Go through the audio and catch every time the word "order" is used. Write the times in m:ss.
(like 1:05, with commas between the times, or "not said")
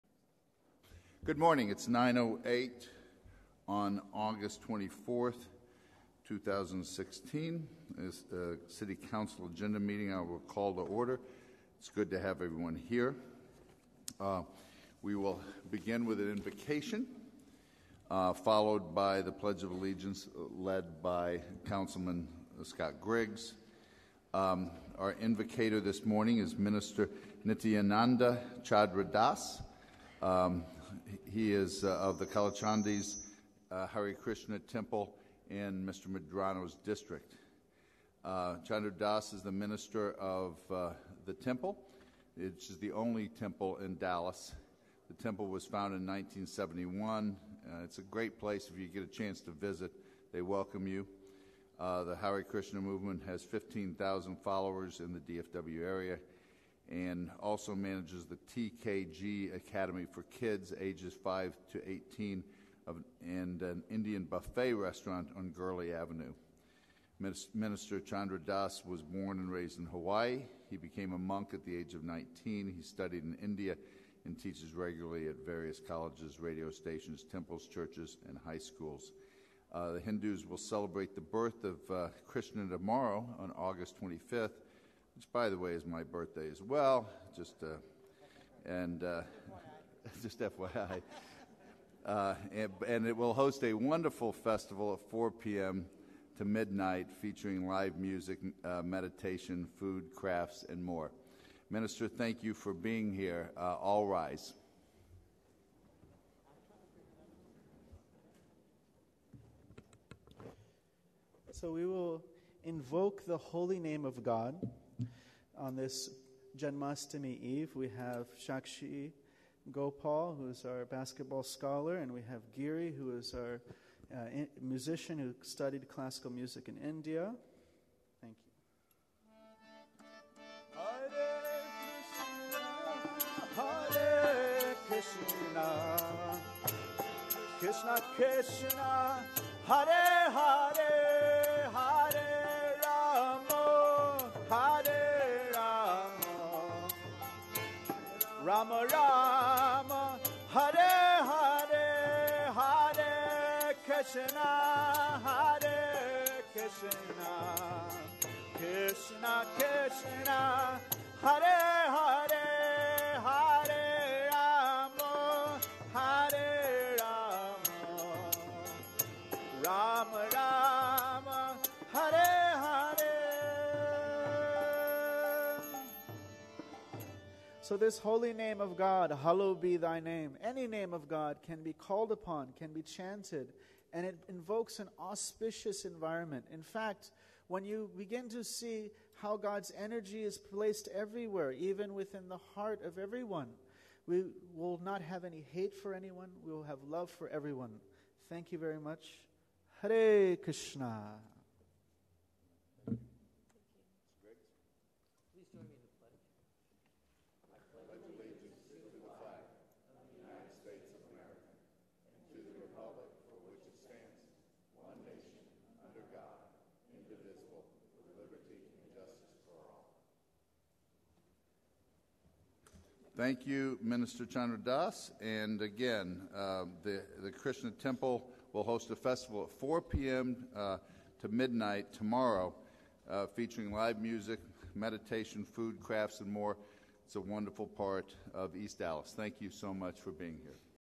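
0:10.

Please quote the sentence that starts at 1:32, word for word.
Uh, and, and, it will host a wonderful festival at 4 p.m.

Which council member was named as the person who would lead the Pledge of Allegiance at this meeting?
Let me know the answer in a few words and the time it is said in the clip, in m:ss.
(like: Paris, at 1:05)
Scott Griggs, at 0:21.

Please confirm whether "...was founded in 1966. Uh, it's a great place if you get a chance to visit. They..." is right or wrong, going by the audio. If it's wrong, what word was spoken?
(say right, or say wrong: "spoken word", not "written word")
wrong: "1971", not "1966".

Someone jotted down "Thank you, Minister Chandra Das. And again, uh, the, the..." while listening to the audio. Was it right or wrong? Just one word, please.
right.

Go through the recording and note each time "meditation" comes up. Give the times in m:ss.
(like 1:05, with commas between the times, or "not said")
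1:38, 3:54.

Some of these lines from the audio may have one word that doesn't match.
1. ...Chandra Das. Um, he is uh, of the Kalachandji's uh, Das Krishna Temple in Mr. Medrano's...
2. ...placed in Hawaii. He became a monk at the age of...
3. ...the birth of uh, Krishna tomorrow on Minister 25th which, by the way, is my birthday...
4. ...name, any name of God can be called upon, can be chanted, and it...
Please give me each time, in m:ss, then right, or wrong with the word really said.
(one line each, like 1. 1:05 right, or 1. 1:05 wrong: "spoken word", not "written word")
1. 0:28 wrong: "Hare", not "Das"
2. 1:09 wrong: "raised", not "placed"
3. 1:21 wrong: "August", not "Minister"
4. 3:00 right.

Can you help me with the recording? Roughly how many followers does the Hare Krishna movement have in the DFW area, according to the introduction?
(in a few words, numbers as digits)
15,000.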